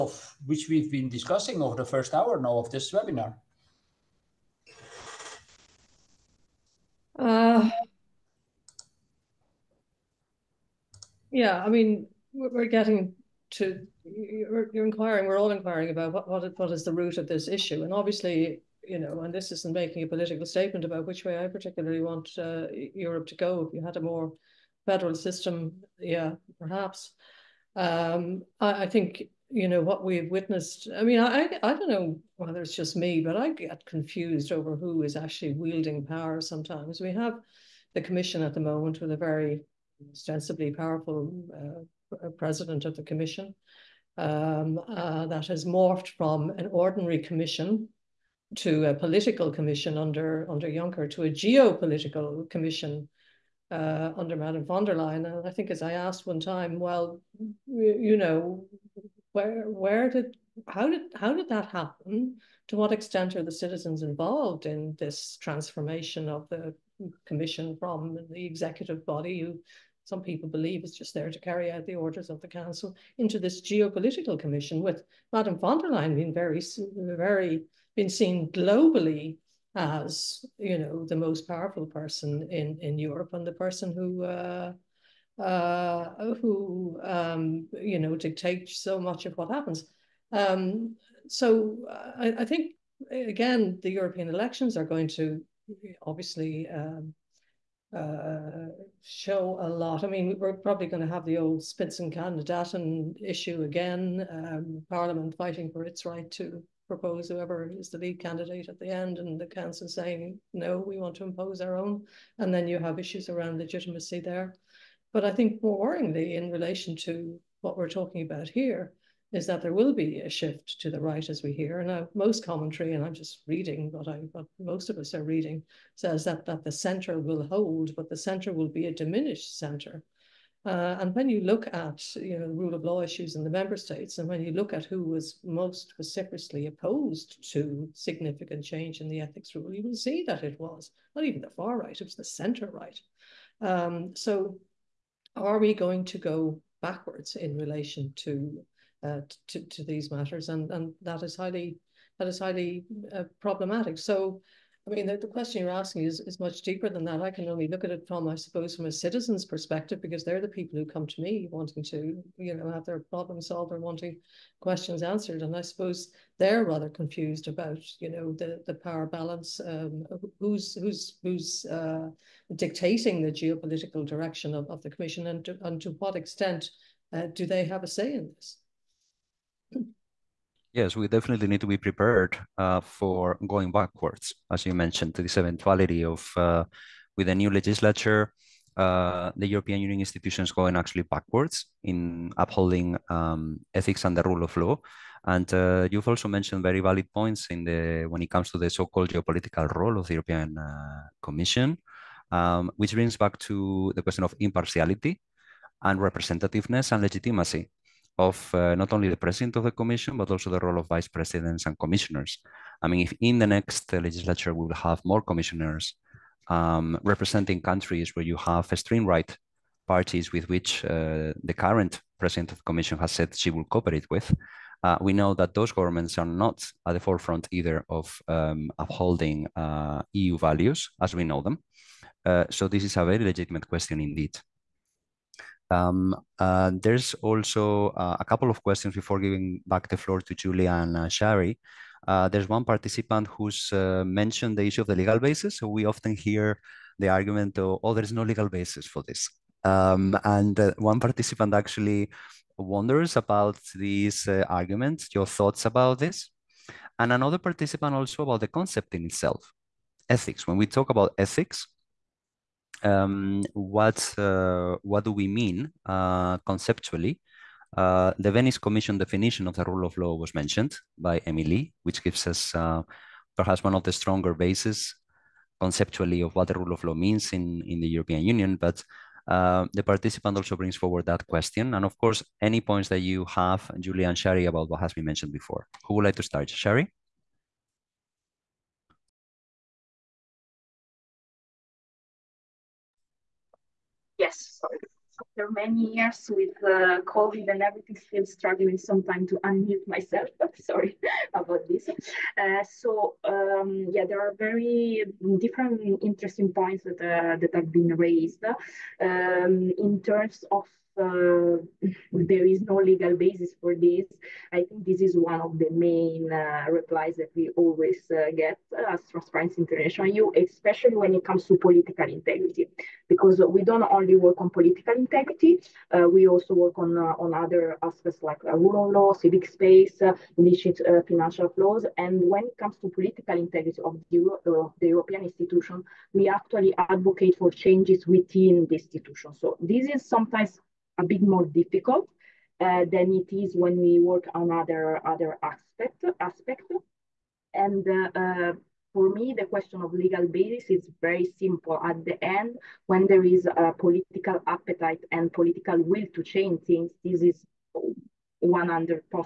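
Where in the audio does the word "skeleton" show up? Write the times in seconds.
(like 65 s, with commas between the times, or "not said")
not said.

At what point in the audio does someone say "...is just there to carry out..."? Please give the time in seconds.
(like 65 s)
70 s.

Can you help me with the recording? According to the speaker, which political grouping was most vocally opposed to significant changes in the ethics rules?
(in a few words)
The centre right.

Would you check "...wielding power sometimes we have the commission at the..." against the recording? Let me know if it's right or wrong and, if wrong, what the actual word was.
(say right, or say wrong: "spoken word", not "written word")
right.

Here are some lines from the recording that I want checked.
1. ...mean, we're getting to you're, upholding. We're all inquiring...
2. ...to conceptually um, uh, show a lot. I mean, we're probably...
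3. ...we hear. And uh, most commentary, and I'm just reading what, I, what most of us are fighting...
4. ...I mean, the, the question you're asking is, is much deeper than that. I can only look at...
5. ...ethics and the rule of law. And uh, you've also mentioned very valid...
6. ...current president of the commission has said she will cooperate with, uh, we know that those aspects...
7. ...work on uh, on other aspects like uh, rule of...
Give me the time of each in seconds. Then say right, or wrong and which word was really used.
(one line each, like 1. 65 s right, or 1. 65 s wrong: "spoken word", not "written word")
1. 11 s wrong: "inquiring", not "upholding"
2. 95 s wrong: "obviously", not "conceptually"
3. 121 s wrong: "reading", not "fighting"
4. 154 s right
5. 193 s right
6. 221 s wrong: "governments", not "aspects"
7. 326 s right.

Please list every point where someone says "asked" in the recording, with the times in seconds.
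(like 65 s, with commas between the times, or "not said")
55 s.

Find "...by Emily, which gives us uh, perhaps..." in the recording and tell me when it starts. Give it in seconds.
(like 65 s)
270 s.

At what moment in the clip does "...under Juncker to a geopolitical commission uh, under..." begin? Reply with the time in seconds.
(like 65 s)
50 s.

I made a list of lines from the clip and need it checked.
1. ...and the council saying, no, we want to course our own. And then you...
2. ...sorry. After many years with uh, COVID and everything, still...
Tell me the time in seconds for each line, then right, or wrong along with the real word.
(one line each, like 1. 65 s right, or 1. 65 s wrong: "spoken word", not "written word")
1. 109 s wrong: "impose", not "course"
2. 294 s right.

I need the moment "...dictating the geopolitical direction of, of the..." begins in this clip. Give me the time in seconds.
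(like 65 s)
172 s.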